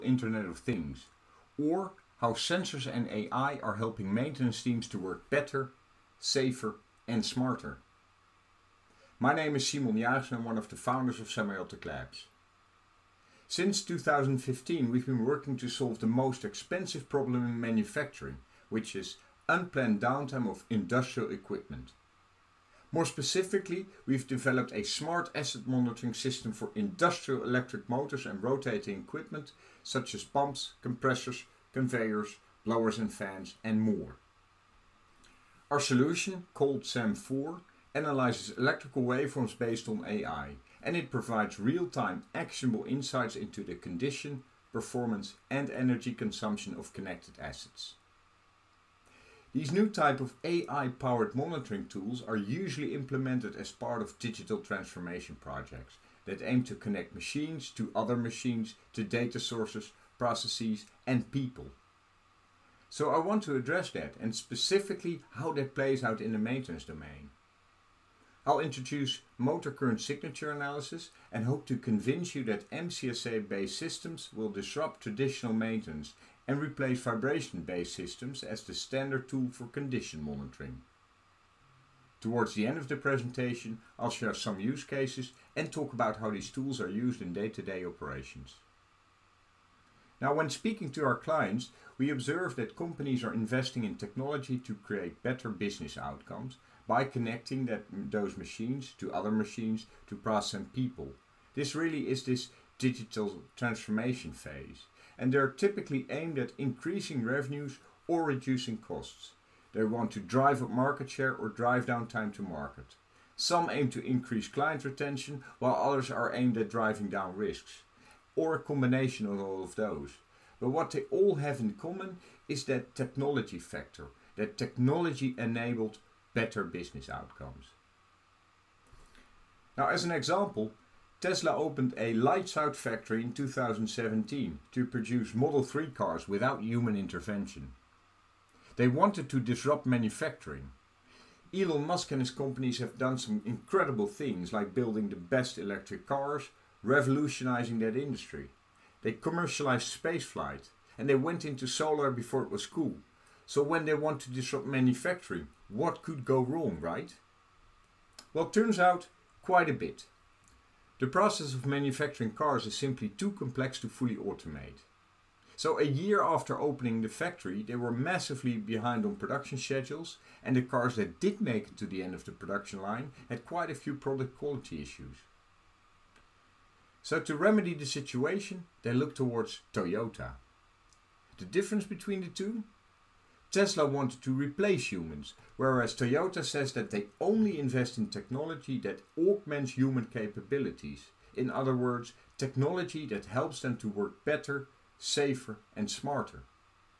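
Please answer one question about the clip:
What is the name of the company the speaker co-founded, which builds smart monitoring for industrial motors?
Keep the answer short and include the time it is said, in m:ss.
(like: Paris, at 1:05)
Semiotic Labs, at 0:11.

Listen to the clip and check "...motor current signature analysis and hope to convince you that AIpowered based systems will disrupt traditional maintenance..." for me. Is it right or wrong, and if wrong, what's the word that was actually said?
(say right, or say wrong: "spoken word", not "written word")
wrong: "MCSA", not "AIpowered".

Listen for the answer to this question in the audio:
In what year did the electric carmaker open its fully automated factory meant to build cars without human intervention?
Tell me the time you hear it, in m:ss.
2:13.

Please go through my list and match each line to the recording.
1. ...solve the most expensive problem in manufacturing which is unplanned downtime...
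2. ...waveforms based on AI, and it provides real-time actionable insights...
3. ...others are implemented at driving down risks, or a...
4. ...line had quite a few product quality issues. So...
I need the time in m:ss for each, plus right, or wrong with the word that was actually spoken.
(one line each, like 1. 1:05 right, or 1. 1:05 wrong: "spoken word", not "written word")
1. 0:15 right
2. 0:39 right
3. 1:55 wrong: "aimed", not "implemented"
4. 2:52 right.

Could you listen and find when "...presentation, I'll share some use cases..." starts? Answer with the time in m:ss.
1:22.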